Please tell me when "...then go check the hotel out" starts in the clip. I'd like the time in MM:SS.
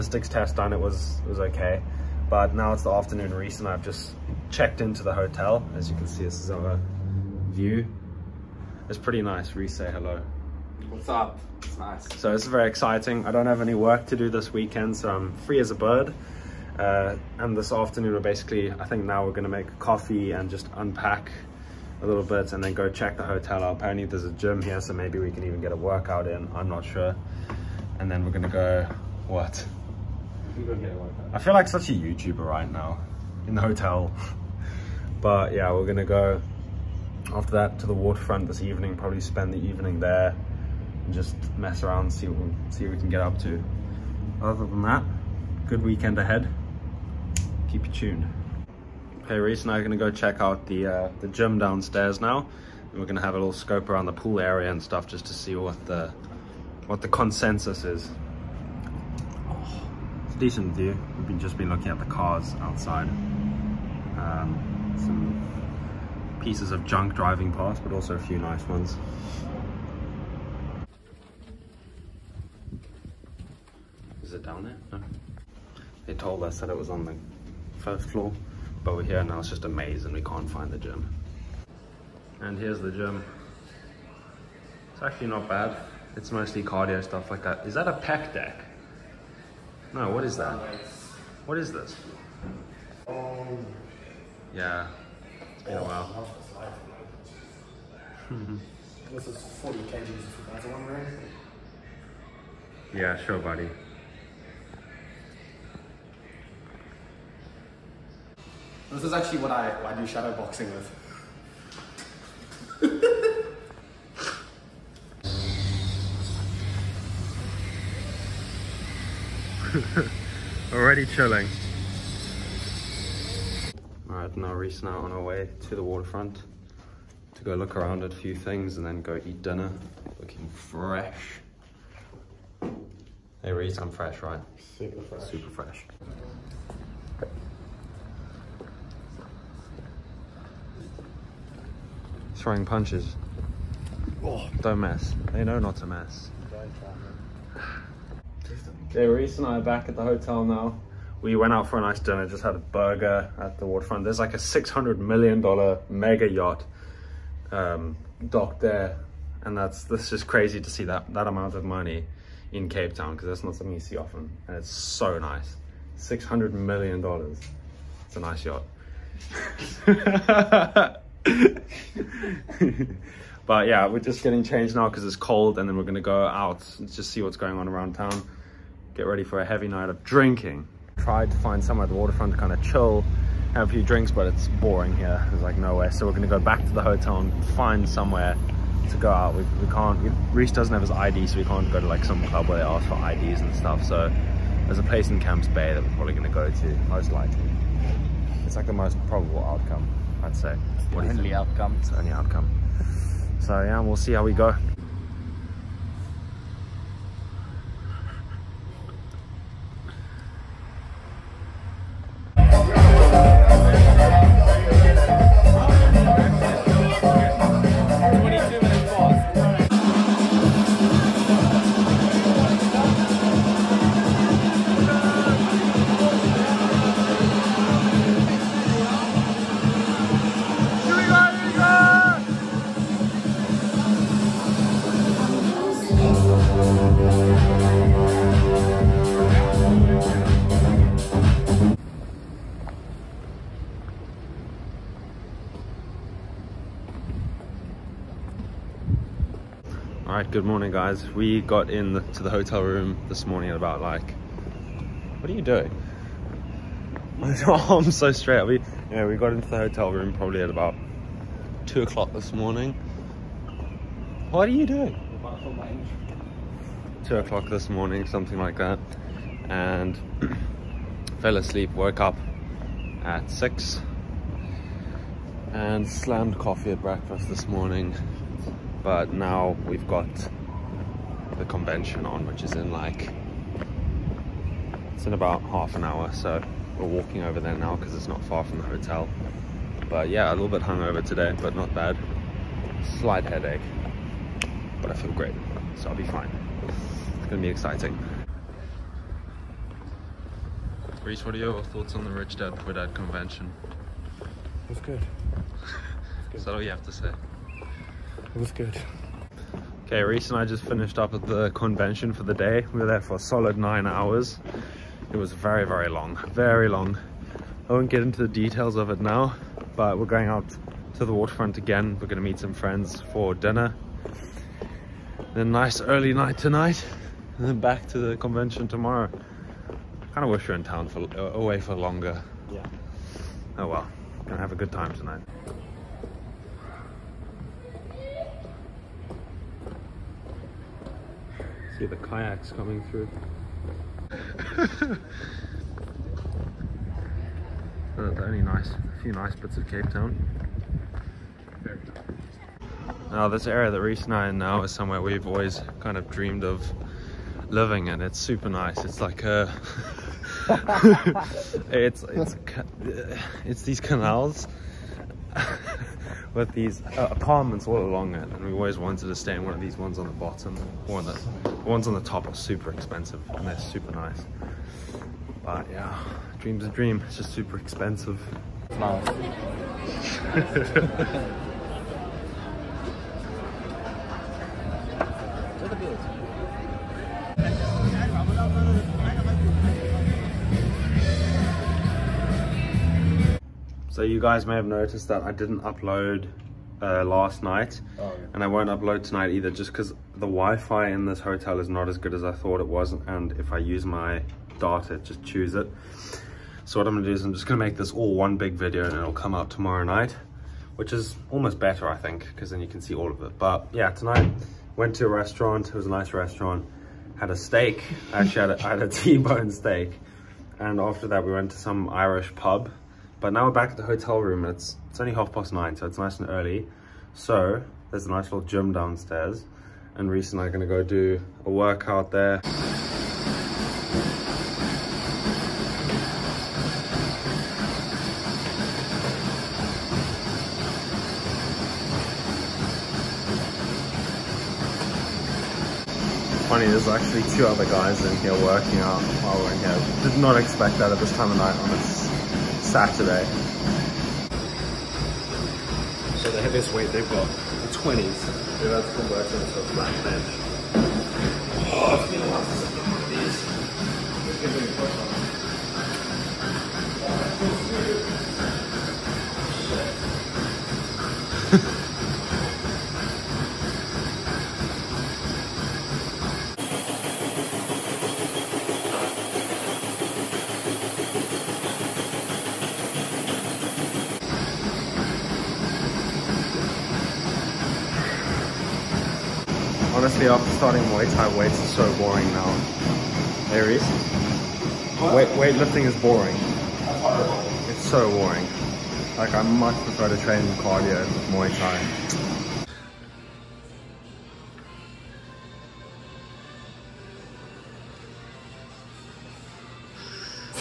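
00:22.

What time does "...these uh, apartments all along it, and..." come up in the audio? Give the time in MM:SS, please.
06:06.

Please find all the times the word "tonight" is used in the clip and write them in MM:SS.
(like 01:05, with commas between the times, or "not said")
05:26, 05:34, 06:39, 06:53.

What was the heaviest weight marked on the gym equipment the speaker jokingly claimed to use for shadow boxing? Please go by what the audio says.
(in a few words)
40 kg.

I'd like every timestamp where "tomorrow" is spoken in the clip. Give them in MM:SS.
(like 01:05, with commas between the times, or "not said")
05:28, 06:49.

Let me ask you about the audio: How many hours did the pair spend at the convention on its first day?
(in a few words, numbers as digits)
9 hours.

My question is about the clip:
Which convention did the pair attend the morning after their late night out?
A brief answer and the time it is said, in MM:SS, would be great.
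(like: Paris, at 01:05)
Rich Dad Poor Dad, at 05:02.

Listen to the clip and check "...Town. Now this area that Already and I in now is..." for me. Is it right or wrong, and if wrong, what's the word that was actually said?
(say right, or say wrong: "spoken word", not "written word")
wrong: "Reese", not "Already".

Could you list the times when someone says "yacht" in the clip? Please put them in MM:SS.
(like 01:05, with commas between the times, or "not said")
02:36, 02:48.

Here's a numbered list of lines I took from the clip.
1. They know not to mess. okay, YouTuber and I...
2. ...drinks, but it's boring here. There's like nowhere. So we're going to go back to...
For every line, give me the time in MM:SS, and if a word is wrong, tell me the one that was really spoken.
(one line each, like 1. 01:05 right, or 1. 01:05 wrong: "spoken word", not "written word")
1. 02:25 wrong: "Reese", not "YouTuber"
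2. 03:03 right.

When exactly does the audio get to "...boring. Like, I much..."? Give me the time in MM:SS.
08:18.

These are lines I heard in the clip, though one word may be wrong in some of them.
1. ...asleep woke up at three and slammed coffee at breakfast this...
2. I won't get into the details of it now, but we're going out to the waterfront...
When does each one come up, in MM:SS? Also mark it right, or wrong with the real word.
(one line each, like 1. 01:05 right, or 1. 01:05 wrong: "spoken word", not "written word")
1. 04:31 wrong: "six", not "three"
2. 05:17 right.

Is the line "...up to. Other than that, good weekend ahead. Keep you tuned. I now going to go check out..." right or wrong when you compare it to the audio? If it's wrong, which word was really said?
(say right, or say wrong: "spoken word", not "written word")
right.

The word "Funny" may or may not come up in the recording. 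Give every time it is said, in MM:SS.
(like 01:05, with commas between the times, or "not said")
07:26.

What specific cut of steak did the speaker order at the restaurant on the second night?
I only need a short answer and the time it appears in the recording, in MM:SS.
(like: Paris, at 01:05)
T-bone, at 06:58.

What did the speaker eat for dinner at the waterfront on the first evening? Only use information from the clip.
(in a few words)
A burger.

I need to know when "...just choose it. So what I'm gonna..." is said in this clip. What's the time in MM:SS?
06:45.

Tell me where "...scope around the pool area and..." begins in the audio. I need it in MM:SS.
00:53.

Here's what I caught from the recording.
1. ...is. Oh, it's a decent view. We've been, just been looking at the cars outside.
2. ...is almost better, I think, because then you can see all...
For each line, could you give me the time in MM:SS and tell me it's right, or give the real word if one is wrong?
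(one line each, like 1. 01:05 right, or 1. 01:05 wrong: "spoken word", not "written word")
1. 00:57 right
2. 06:50 right.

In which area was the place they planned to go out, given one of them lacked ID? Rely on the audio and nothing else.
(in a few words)
Camps Bay.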